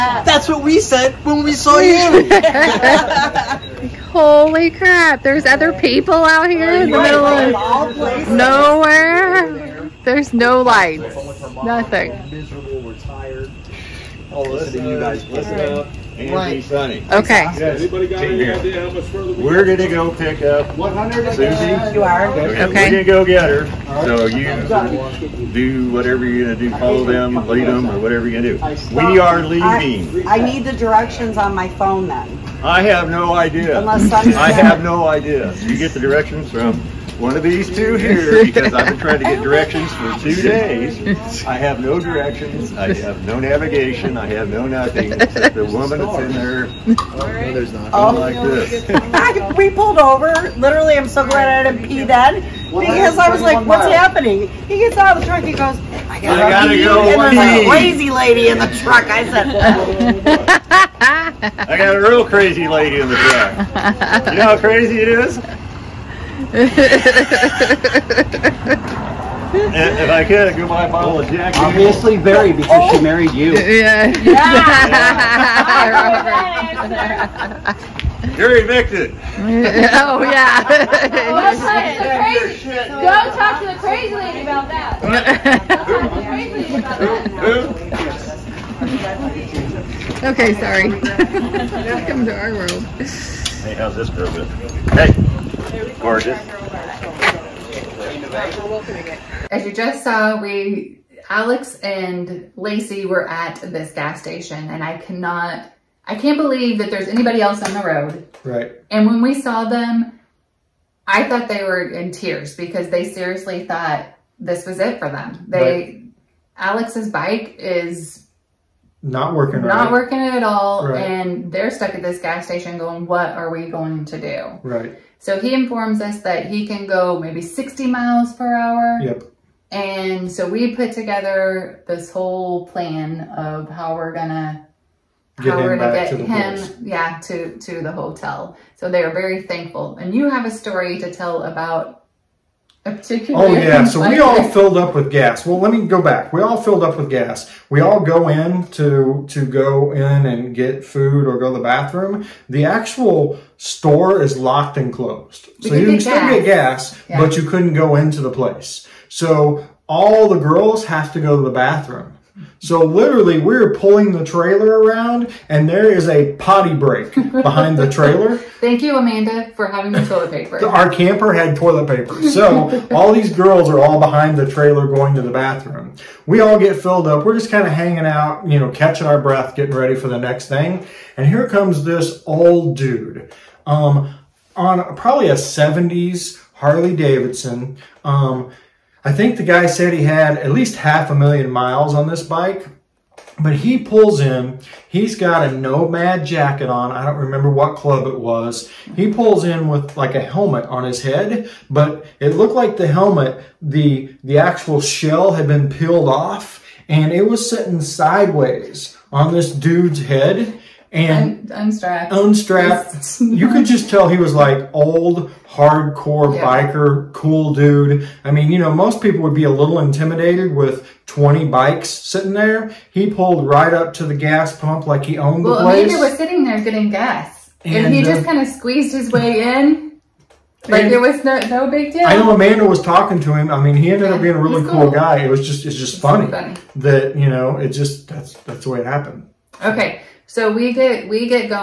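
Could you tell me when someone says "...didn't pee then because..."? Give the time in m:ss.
0:51.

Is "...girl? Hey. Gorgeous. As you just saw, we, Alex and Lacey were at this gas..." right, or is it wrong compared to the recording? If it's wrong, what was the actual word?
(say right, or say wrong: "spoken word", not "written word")
right.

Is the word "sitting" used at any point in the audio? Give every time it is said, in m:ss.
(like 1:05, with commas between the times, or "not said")
3:27, 3:41, 3:46.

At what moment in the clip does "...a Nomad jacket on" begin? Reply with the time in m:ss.
3:15.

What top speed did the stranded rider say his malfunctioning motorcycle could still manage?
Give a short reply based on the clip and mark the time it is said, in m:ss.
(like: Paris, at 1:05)
60 miles per hour, at 2:07.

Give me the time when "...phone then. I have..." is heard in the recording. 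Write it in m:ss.
0:31.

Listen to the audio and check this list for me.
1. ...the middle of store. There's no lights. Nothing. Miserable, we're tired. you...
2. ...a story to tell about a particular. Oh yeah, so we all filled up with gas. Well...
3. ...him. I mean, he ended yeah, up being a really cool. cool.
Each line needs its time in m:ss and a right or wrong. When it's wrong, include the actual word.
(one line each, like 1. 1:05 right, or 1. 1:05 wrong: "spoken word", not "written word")
1. 0:06 wrong: "nowhere", not "store"
2. 2:20 right
3. 3:53 right.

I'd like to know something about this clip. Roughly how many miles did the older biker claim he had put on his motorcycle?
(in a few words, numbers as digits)
half a million.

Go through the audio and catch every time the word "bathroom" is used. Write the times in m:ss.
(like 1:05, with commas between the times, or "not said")
2:31, 2:41, 2:55.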